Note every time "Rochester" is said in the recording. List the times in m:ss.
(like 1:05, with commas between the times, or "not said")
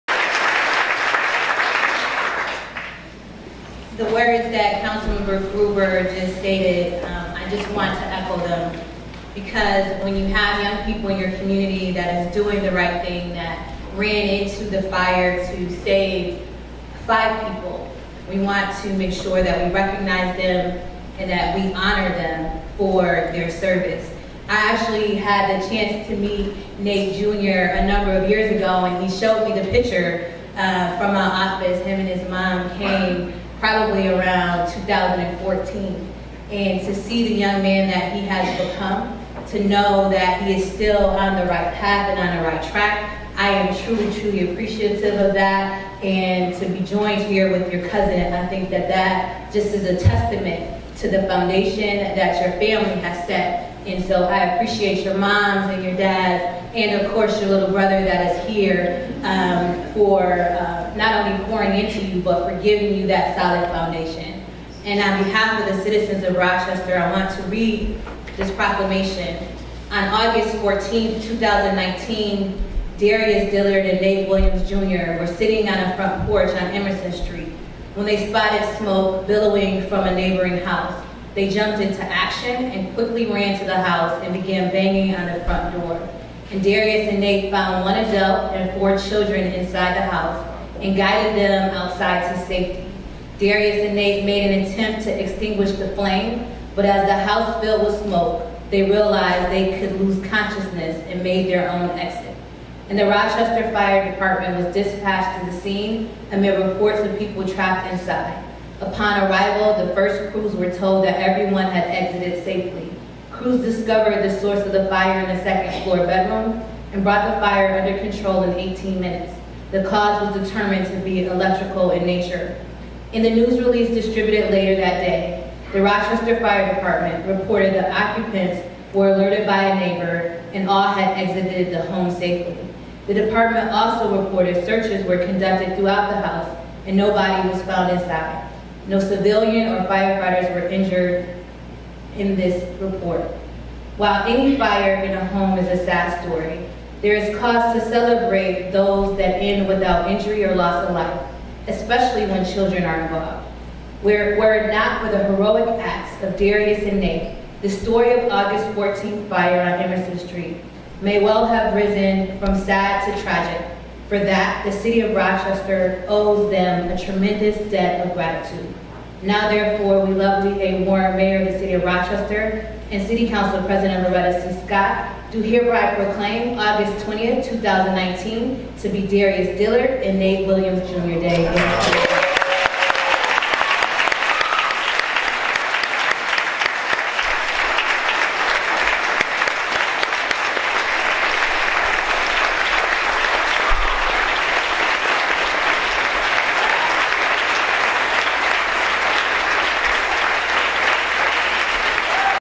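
1:06, 1:43, 2:05, 2:45, 2:51.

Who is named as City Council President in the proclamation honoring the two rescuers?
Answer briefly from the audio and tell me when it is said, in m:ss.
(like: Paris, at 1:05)
Loretta C. Scott, at 2:54.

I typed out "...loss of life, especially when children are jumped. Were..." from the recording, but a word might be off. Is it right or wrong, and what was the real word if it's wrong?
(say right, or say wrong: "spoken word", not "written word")
wrong: "involved", not "jumped".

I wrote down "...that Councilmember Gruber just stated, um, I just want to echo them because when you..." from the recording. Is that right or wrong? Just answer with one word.
right.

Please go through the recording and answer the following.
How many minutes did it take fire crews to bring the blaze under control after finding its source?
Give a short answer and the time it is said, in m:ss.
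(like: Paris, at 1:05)
18, at 1:58.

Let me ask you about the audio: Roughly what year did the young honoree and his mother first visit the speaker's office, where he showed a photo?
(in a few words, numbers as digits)
2014.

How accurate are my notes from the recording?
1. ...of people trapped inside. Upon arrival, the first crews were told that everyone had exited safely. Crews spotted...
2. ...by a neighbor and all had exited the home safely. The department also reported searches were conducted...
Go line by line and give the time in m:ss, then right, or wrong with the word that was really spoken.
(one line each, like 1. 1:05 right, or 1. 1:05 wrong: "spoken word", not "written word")
1. 1:46 wrong: "discovered", not "spotted"
2. 2:09 right.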